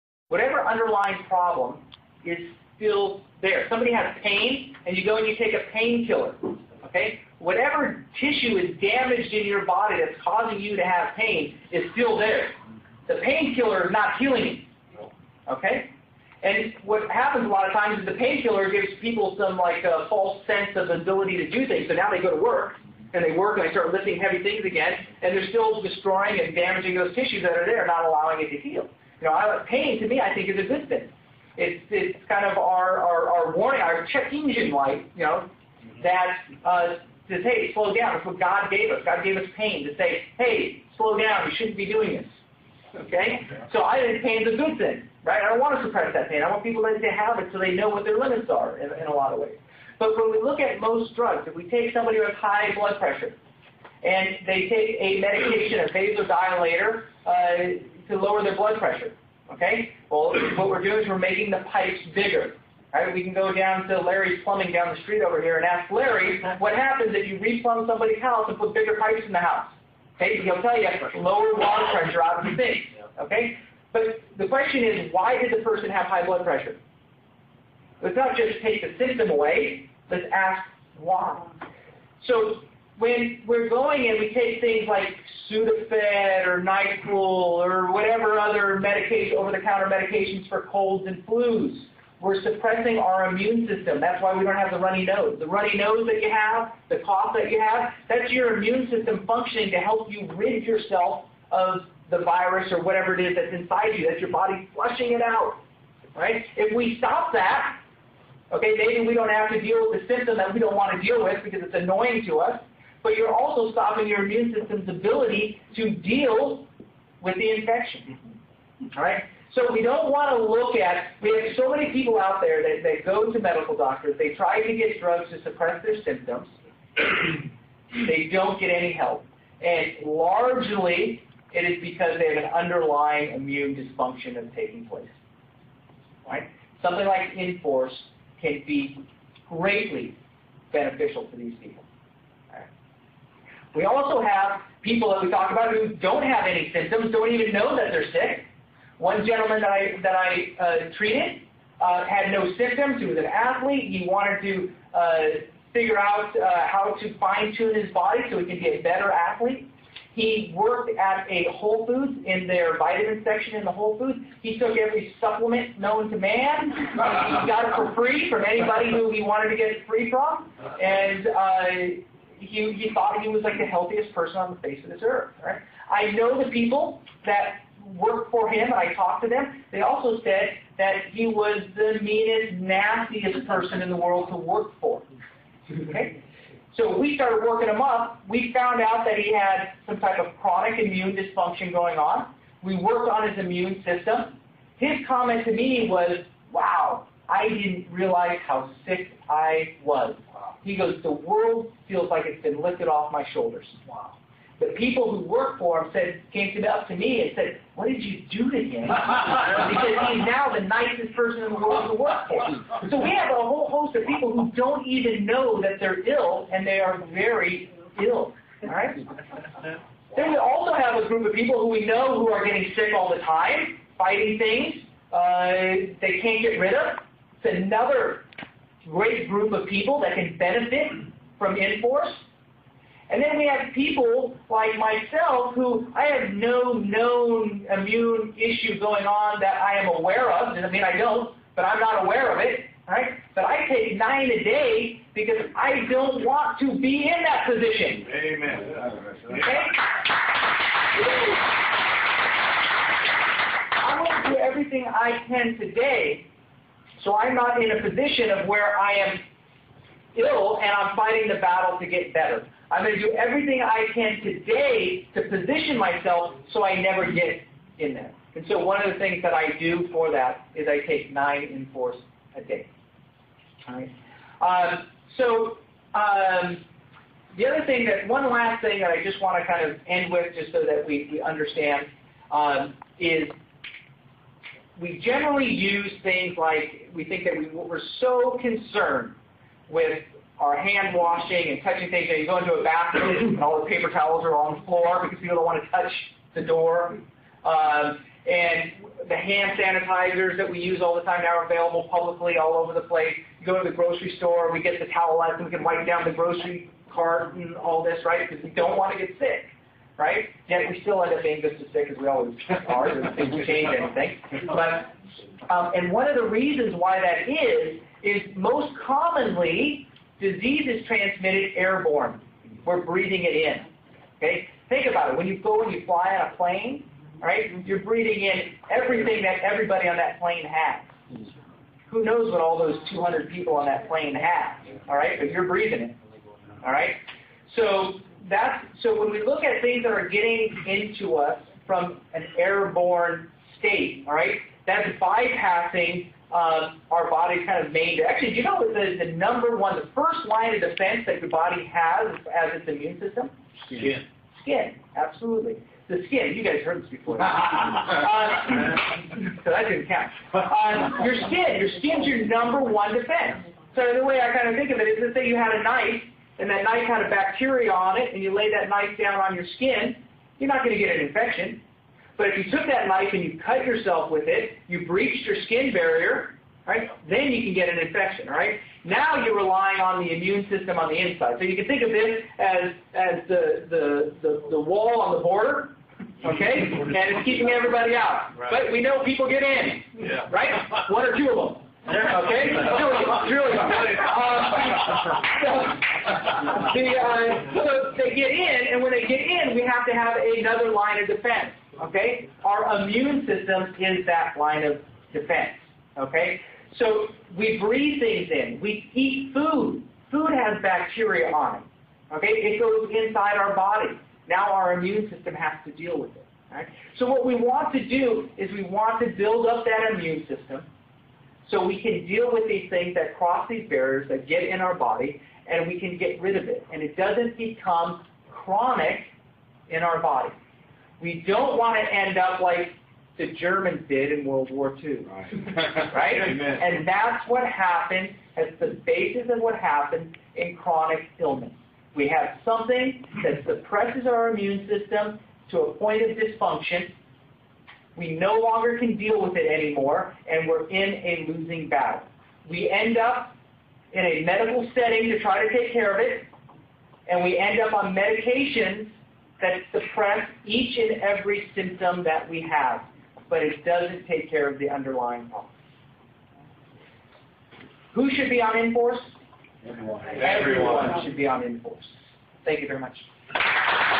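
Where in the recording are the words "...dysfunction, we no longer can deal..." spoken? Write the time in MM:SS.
07:26.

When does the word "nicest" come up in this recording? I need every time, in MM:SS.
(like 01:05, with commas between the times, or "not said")
03:30.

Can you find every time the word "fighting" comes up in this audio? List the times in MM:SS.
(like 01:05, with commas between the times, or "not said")
03:43, 04:20.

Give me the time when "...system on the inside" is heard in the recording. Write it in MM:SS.
06:20.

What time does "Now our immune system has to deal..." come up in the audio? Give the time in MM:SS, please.
06:54.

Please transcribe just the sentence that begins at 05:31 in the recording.
Who knows what all those 200 people on that plane have, all right?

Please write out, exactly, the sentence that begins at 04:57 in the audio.
Um, and the hand sanitizers that we use all the time now are available publicly all over the place.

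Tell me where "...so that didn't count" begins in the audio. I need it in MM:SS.
05:59.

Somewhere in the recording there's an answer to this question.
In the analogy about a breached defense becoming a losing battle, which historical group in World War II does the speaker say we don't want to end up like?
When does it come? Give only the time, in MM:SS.
07:13.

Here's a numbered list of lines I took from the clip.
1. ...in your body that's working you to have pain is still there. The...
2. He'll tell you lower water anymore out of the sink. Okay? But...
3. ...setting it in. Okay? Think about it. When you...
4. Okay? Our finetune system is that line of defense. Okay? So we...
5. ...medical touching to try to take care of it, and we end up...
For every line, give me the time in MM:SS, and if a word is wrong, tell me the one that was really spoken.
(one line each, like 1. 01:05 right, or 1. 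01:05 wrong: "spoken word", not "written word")
1. 00:09 wrong: "causing", not "working"
2. 01:10 wrong: "pressure", not "anymore"
3. 05:22 wrong: "breathing", not "setting"
4. 06:41 wrong: "immune", not "finetune"
5. 07:34 wrong: "setting", not "touching".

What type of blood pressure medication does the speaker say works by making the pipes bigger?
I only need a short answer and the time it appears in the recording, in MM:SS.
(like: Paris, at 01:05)
vasodilator, at 00:55.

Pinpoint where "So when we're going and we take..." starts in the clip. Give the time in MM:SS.
01:22.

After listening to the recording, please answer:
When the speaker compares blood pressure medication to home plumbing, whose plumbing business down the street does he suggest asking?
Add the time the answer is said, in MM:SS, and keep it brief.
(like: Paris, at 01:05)
Larry's Plumbing, at 01:03.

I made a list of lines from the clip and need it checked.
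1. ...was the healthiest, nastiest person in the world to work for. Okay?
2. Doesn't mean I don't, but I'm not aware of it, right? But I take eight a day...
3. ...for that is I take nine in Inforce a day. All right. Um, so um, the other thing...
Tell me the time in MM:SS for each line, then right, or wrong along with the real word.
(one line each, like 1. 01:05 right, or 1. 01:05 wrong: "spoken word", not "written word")
1. 03:01 wrong: "meanest", not "healthiest"
2. 04:00 wrong: "nine", not "eight"
3. 04:29 right.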